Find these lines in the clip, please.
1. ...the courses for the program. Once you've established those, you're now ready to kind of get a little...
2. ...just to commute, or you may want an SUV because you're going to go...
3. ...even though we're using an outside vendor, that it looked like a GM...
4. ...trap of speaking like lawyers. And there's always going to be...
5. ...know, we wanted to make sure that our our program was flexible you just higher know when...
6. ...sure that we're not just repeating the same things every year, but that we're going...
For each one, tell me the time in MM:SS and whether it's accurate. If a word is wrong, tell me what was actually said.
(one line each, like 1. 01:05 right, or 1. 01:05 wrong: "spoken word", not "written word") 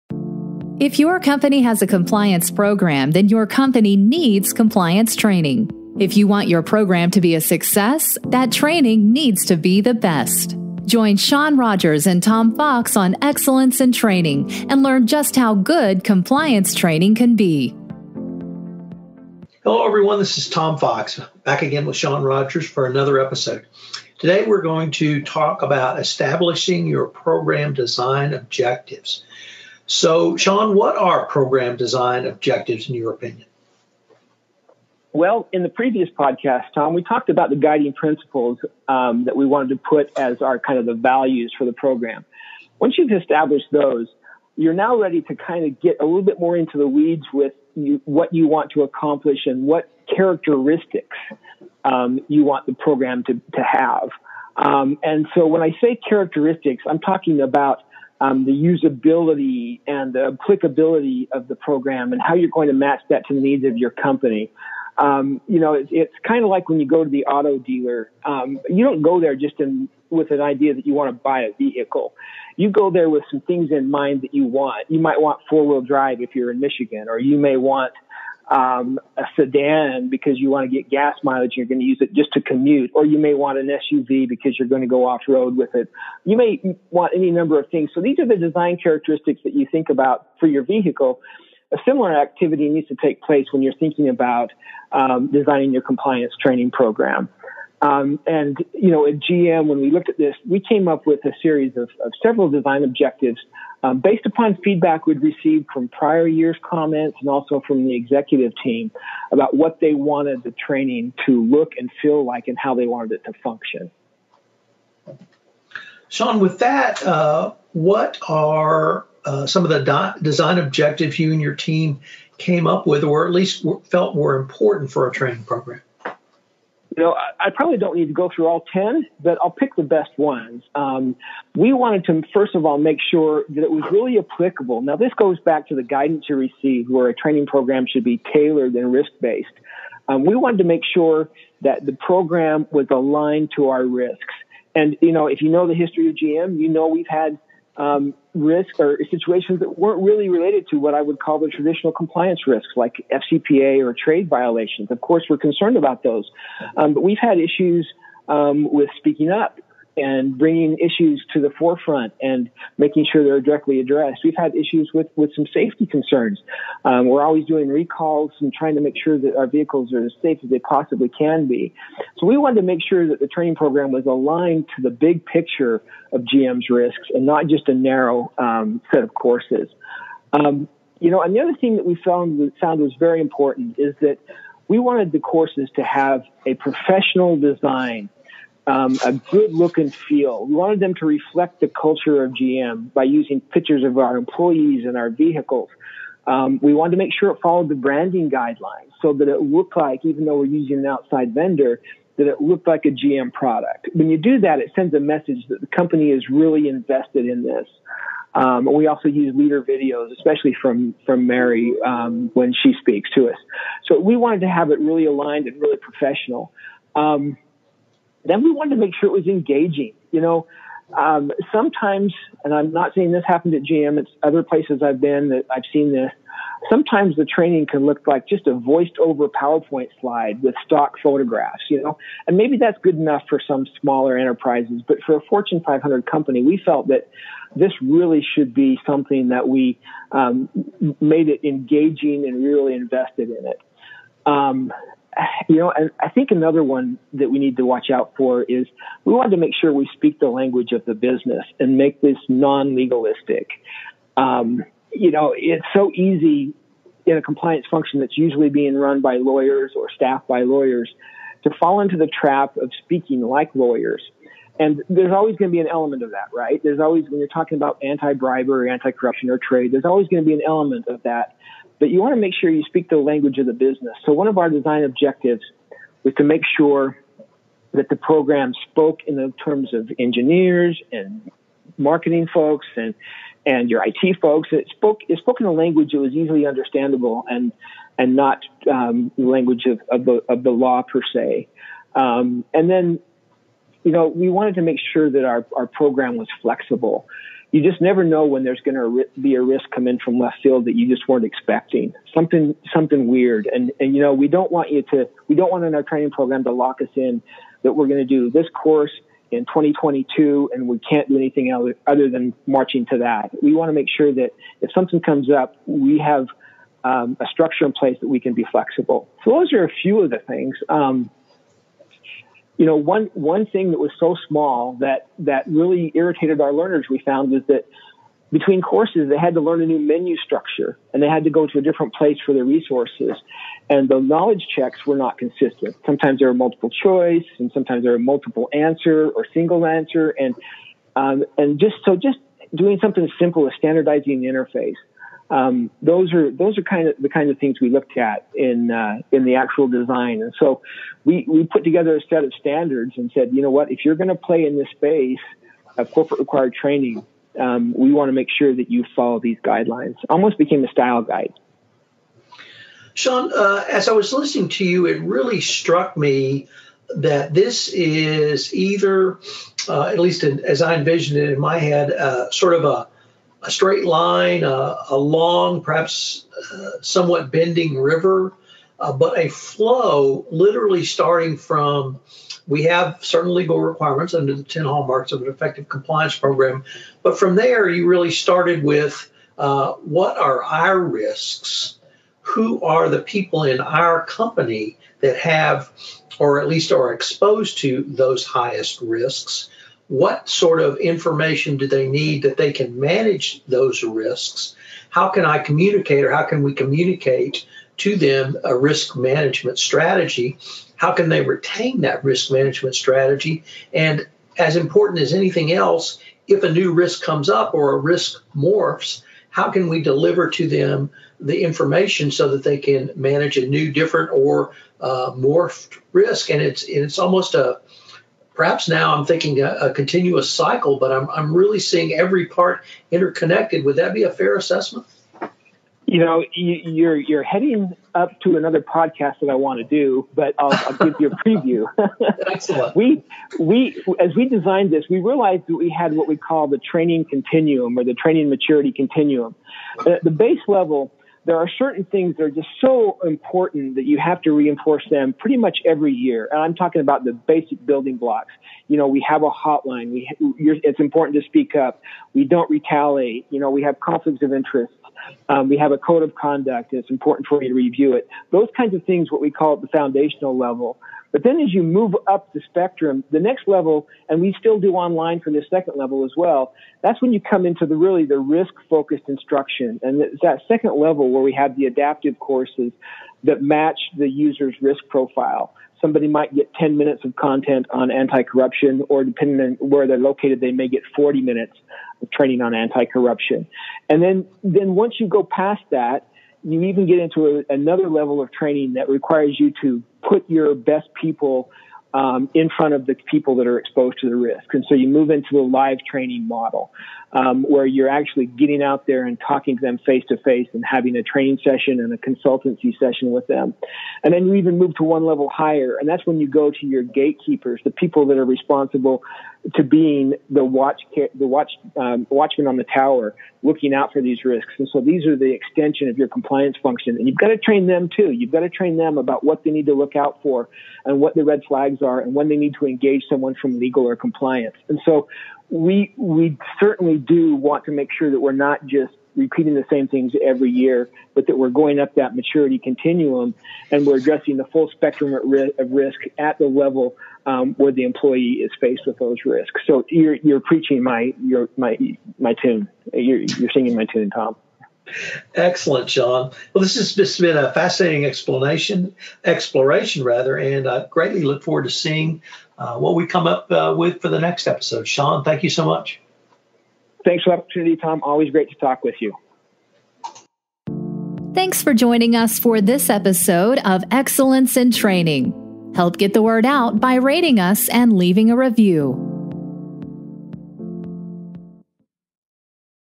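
1. 00:40 wrong: "values", not "courses"
2. 01:22 right
3. 03:20 right
4. 04:22 right
5. 04:53 wrong: "never", not "higher"
6. 08:57 right.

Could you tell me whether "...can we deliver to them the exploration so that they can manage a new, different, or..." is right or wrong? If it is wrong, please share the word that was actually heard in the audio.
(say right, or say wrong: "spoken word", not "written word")
wrong: "information", not "exploration".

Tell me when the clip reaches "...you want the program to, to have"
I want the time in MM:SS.
00:52.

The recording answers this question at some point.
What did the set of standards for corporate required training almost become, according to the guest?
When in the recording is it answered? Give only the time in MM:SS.
06:00.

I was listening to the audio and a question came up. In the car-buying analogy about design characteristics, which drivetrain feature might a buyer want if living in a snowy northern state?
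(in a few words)
four wheel drive.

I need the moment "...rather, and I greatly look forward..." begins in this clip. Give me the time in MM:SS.
09:20.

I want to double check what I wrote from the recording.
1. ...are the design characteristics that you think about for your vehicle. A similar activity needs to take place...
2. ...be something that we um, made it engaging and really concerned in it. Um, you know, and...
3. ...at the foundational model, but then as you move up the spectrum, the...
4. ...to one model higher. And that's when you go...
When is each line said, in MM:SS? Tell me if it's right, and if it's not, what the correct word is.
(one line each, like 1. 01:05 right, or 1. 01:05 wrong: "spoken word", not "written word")
1. 01:28 right
2. 03:58 wrong: "invested", not "concerned"
3. 07:49 wrong: "level", not "model"
4. 08:34 wrong: "level", not "model".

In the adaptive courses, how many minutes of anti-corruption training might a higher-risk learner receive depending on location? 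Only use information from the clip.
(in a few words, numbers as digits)
40 minutes.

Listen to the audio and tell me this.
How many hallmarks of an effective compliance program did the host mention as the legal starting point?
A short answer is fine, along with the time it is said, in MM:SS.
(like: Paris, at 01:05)
10, at 06:24.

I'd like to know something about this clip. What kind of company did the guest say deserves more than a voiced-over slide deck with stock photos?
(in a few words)
Fortune 500 company.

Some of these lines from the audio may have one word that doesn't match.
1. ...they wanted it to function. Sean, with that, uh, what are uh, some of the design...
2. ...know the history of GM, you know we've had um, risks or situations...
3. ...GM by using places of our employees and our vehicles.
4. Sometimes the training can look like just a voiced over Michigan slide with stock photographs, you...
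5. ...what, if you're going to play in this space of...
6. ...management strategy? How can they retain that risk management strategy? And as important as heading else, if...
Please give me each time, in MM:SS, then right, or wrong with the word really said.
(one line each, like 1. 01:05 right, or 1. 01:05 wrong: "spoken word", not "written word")
1. 01:52 right
2. 02:25 right
3. 03:12 wrong: "pictures", not "places"
4. 03:46 wrong: "PowerPoint", not "Michigan"
5. 05:53 right
6. 06:48 wrong: "anything", not "heading".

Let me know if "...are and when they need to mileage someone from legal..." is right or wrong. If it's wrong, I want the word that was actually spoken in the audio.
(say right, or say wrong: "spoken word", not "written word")
wrong: "engage", not "mileage".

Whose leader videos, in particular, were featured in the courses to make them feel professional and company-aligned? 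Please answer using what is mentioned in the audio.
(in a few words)
Mary.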